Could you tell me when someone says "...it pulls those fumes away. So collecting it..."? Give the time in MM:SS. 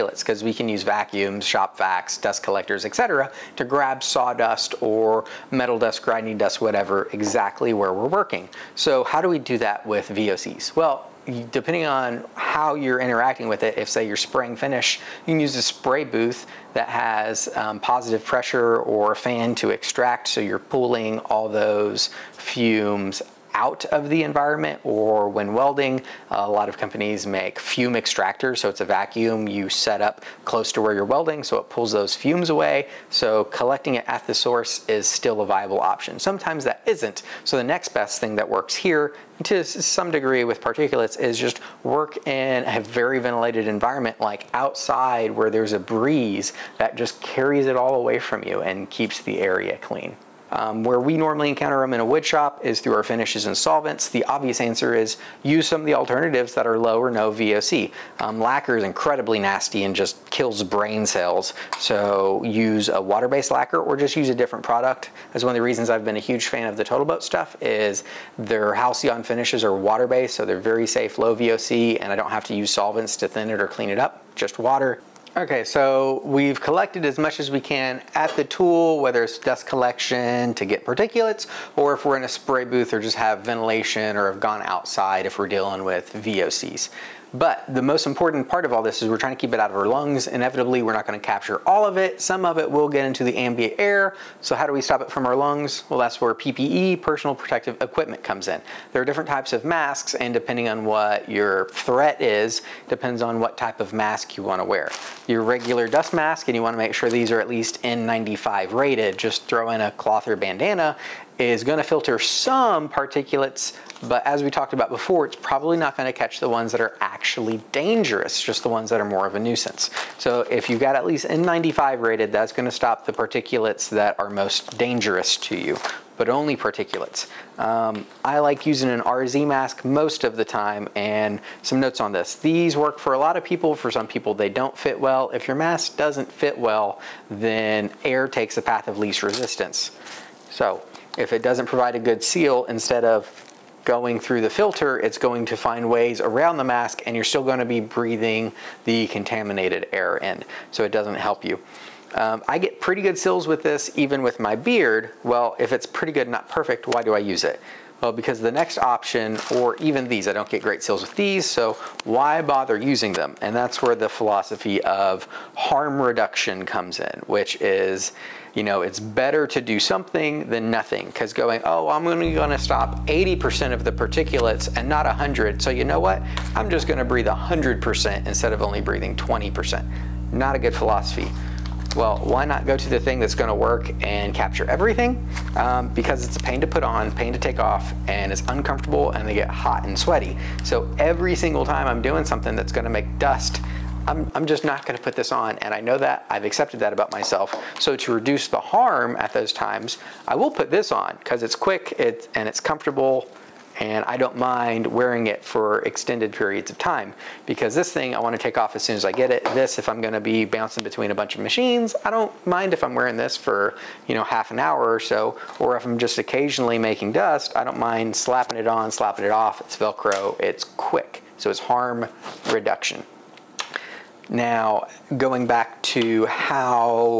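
00:31.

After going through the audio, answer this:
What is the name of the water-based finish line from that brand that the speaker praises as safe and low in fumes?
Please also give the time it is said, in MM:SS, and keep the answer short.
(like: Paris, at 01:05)
Halcyon, at 01:08.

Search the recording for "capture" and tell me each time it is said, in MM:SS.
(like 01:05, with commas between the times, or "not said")
01:31, 03:04.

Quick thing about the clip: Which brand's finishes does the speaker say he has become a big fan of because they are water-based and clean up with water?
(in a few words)
Total Boat.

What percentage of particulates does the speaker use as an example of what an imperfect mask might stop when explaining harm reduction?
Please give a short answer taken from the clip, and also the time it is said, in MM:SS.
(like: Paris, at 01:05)
80%, at 02:53.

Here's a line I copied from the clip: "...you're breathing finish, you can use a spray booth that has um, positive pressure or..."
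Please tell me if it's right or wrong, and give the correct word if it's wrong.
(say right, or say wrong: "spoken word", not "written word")
wrong: "spraying", not "breathing".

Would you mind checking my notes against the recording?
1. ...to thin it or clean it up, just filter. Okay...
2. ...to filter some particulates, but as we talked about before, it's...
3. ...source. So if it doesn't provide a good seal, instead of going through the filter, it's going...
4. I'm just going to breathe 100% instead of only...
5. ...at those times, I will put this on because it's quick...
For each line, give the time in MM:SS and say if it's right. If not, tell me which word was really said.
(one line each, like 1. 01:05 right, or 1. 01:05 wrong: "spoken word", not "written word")
1. 01:13 wrong: "water", not "filter"
2. 01:51 right
3. 02:19 wrong: "resistance", not "source"
4. 02:56 right
5. 03:19 right.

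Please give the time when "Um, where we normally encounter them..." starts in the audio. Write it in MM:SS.
00:50.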